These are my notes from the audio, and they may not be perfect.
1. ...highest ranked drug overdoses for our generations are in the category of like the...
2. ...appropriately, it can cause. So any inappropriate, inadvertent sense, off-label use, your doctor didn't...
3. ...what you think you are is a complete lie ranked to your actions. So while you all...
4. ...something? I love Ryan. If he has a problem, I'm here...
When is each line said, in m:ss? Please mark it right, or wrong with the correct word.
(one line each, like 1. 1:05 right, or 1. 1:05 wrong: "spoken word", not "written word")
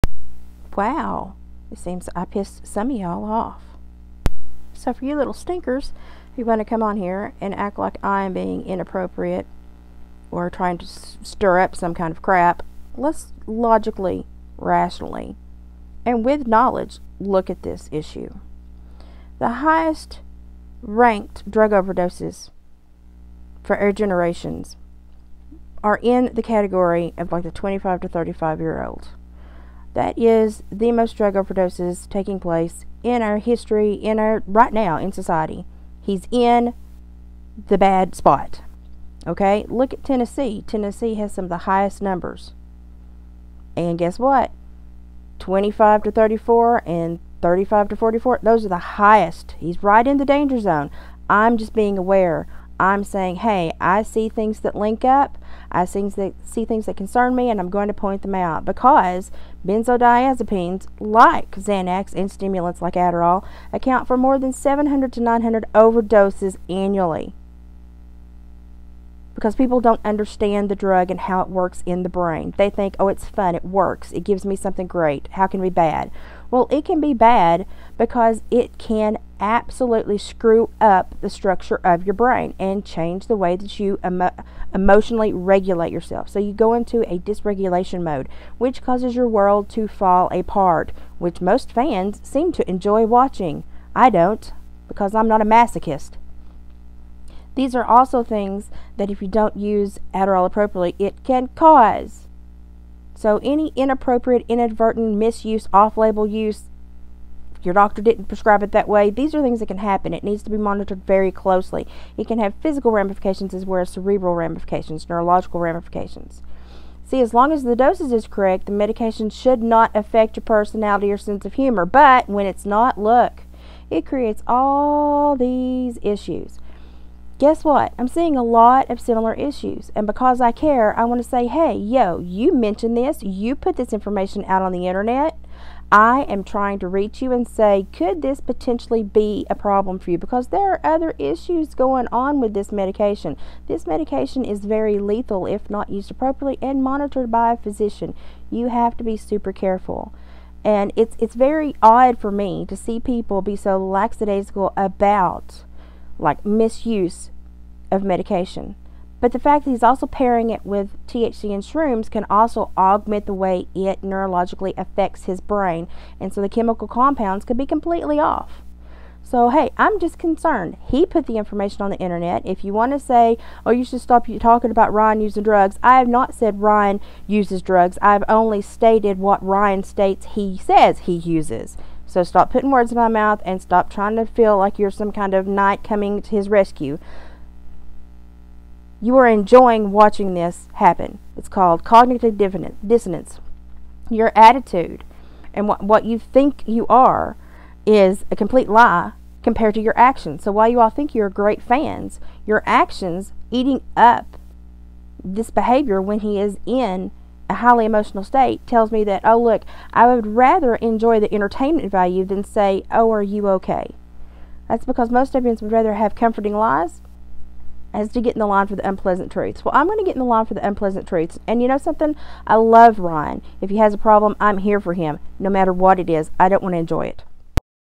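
1. 0:19 right
2. 1:40 wrong: "misuse", not "sense"
3. 3:15 wrong: "compared", not "ranked"
4. 3:41 right.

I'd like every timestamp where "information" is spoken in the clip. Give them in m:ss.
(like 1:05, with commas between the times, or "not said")
2:13, 2:51.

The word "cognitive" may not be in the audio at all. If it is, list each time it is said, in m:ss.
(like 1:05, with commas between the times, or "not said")
3:11.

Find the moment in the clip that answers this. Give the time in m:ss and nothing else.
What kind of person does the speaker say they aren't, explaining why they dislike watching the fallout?
1:35.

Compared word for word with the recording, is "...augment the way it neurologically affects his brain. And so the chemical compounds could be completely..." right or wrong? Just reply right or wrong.
right.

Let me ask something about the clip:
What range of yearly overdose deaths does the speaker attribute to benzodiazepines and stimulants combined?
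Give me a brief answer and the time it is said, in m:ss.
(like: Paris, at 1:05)
700 to 900, at 1:04.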